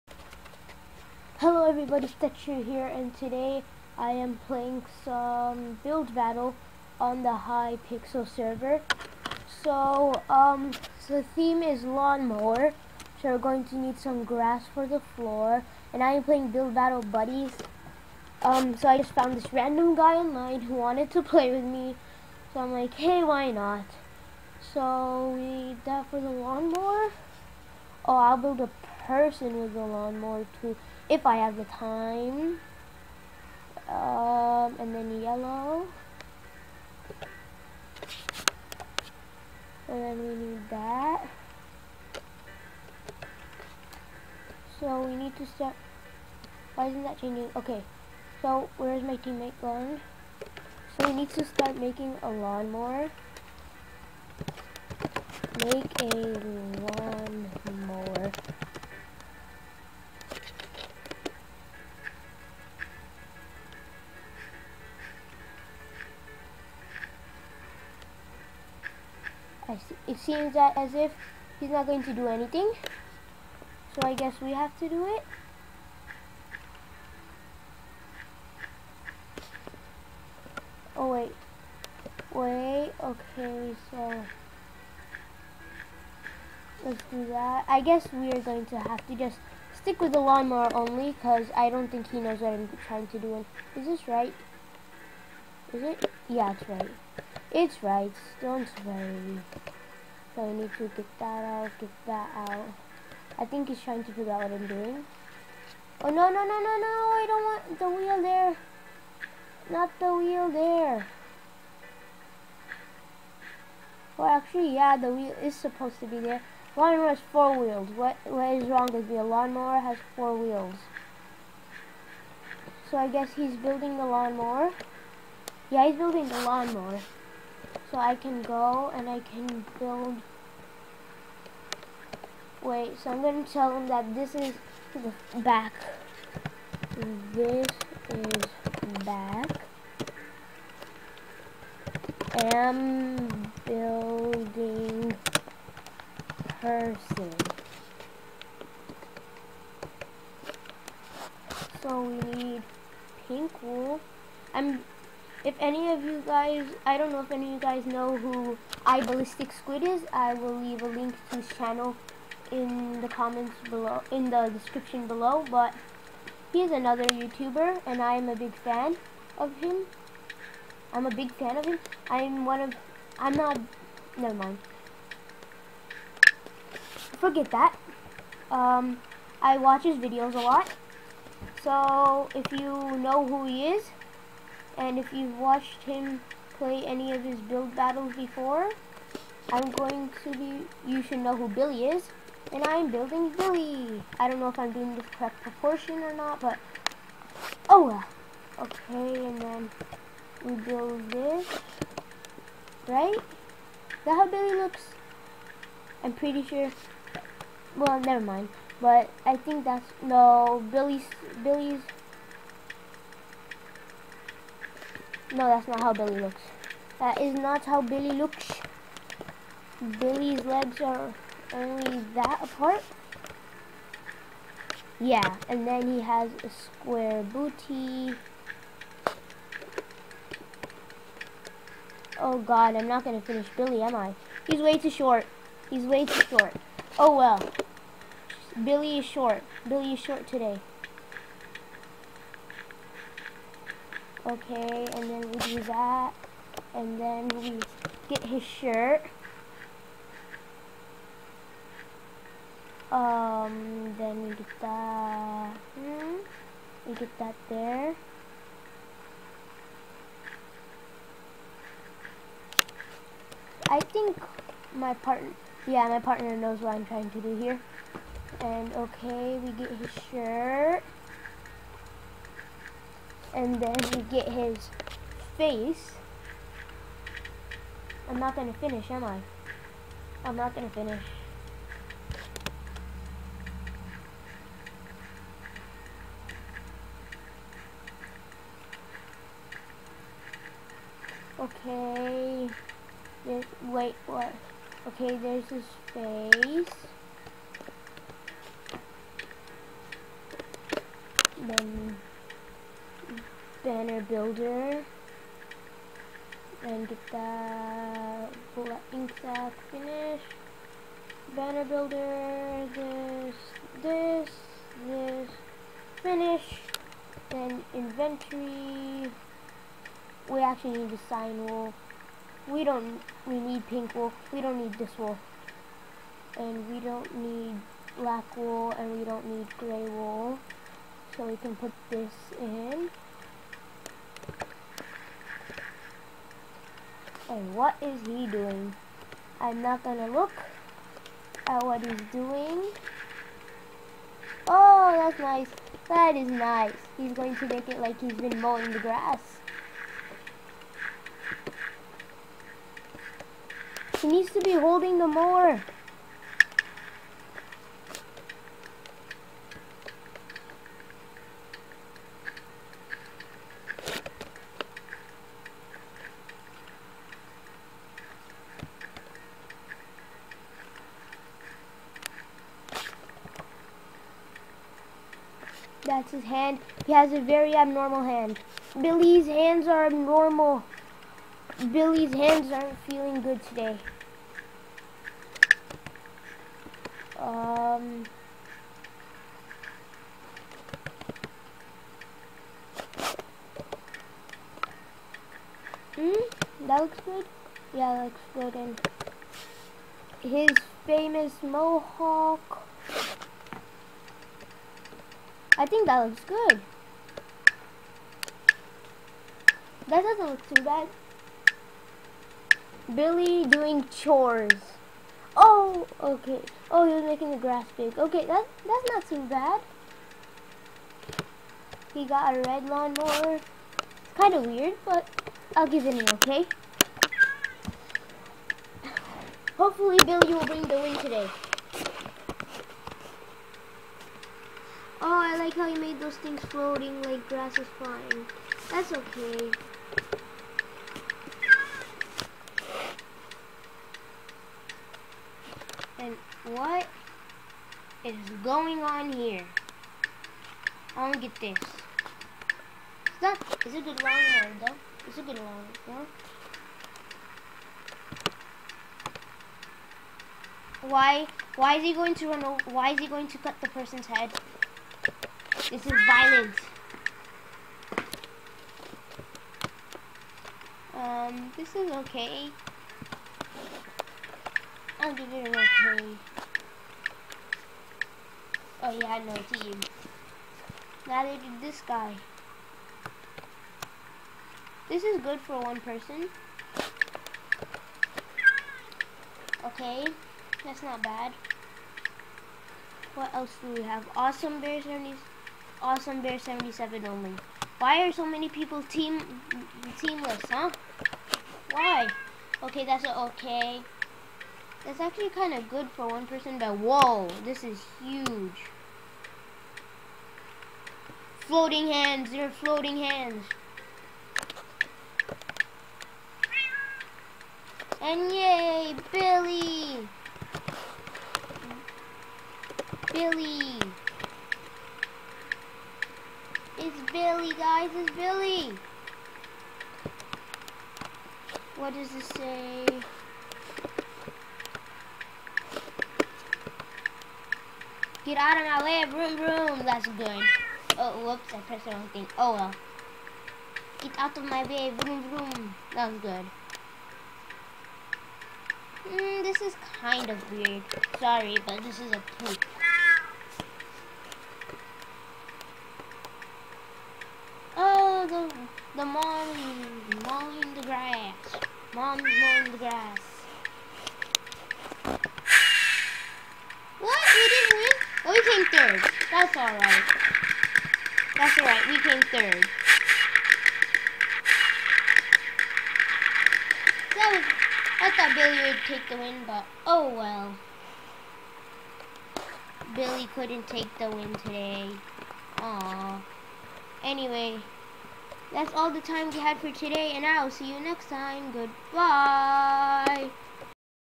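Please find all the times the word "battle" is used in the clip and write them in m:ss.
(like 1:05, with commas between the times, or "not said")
0:06, 0:16, 3:07.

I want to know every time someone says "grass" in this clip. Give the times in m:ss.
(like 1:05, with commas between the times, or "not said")
0:14, 5:48, 6:57, 7:17, 9:22.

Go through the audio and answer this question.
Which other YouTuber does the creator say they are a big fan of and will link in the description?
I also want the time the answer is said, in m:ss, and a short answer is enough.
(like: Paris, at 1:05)
iBallisticSquid, at 2:38.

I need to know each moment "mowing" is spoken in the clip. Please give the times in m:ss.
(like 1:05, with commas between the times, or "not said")
5:48, 9:22.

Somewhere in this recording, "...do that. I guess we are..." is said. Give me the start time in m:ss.
1:27.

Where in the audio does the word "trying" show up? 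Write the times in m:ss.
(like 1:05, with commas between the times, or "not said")
1:32, 1:43, 4:26.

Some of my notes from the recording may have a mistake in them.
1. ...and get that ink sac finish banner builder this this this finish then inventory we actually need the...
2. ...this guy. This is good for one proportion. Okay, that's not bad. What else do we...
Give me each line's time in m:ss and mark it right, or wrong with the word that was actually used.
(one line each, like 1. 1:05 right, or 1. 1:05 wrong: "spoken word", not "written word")
1. 5:06 right
2. 8:01 wrong: "person", not "proportion".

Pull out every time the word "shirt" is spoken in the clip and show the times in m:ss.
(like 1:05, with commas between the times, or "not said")
4:08, 4:30.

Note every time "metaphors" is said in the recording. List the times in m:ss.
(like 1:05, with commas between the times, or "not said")
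not said.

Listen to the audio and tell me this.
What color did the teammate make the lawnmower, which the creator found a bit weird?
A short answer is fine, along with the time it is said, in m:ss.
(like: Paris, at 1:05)
Red, at 7:02.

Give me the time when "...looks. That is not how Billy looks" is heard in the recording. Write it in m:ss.
3:36.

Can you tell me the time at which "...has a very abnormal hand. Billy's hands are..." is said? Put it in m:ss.
6:16.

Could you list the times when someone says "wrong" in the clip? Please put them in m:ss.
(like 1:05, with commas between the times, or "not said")
1:58, 9:01.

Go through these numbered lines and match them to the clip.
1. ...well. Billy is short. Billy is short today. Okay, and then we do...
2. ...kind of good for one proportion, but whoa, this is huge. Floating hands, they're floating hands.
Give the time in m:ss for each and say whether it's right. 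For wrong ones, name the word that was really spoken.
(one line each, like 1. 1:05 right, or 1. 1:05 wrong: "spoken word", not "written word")
1. 3:57 right
2. 8:25 wrong: "person", not "proportion".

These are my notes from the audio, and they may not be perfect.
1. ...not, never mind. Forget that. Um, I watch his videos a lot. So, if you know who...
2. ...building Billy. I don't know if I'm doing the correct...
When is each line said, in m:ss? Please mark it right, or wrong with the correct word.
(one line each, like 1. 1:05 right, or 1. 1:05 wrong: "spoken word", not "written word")
1. 2:53 right
2. 3:12 right.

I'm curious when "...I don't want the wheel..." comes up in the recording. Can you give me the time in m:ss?
1:47.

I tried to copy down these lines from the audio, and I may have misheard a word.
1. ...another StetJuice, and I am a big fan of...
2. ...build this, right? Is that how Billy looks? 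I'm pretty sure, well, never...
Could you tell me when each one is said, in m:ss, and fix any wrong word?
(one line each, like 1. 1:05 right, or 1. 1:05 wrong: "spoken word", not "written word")
1. 2:46 wrong: "YouTuber", not "StetJuice"
2. 3:20 right.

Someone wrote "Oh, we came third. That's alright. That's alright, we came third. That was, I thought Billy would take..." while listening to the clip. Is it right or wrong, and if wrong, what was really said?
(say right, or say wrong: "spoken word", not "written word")
right.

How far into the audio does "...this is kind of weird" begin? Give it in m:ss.
9:09.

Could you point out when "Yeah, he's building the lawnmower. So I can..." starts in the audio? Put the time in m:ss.
2:05.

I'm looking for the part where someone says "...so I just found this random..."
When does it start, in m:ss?
0:18.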